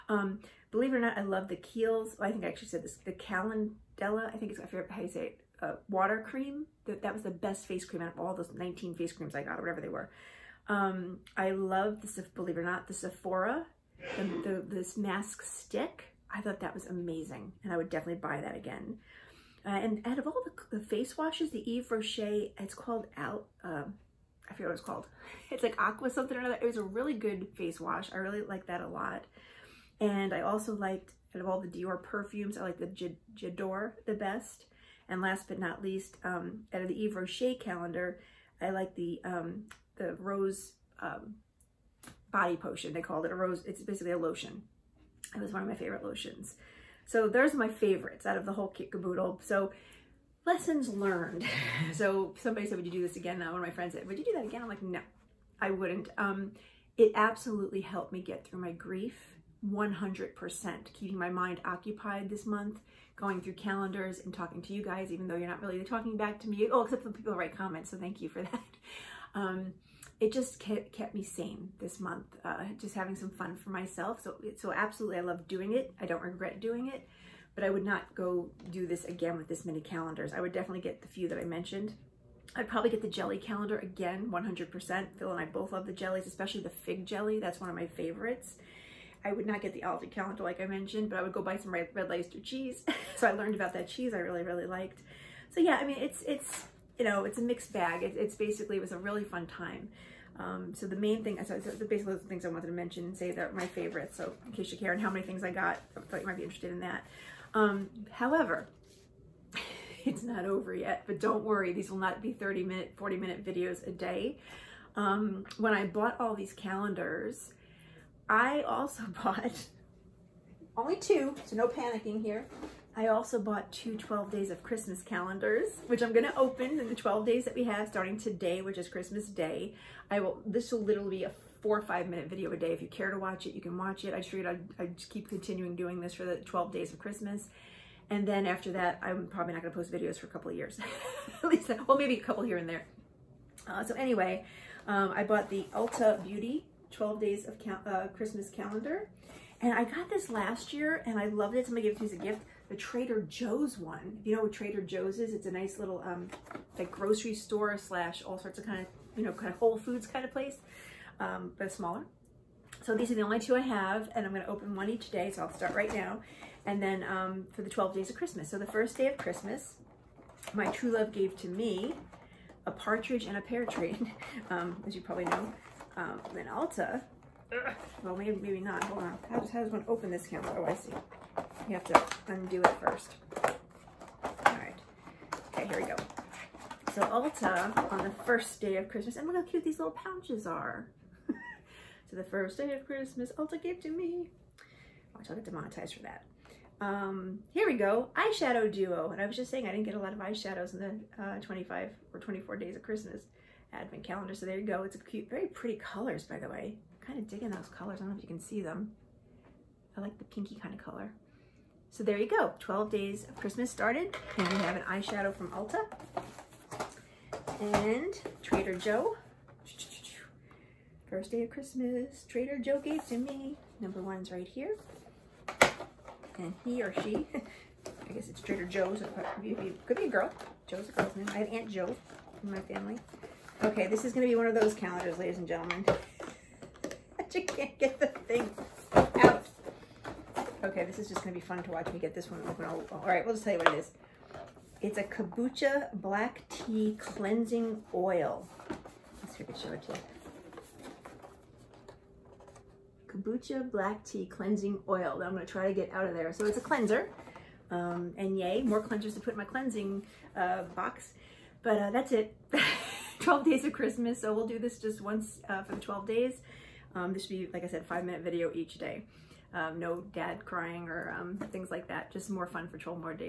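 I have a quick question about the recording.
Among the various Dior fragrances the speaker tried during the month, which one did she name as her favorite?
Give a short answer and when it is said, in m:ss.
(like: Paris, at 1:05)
J'adore, at 0:33.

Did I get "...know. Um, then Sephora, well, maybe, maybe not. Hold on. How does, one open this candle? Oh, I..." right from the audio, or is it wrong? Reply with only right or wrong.
wrong.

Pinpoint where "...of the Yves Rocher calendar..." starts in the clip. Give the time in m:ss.
0:36.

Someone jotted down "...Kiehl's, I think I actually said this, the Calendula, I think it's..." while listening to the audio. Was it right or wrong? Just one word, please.
right.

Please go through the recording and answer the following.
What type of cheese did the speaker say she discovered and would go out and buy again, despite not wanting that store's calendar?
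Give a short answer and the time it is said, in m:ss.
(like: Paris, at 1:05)
Red Leicester, at 1:31.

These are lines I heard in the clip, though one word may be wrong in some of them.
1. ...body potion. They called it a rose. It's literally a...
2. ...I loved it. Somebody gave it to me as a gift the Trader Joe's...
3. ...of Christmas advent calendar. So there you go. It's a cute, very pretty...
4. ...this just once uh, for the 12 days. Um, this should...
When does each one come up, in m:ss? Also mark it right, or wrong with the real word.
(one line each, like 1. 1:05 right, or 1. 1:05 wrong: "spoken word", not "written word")
1. 0:42 wrong: "basically", not "literally"
2. 2:31 right
3. 3:22 right
4. 4:24 right.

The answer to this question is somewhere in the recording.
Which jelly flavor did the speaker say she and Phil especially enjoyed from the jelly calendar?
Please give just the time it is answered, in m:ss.
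1:26.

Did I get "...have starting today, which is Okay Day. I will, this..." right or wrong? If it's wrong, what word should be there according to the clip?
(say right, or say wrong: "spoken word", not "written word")
wrong: "Christmas", not "Okay".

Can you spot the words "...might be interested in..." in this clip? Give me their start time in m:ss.
1:46.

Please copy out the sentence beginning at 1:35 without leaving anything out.
So yeah, I mean, it's, it's, you know, it's a mixed bag.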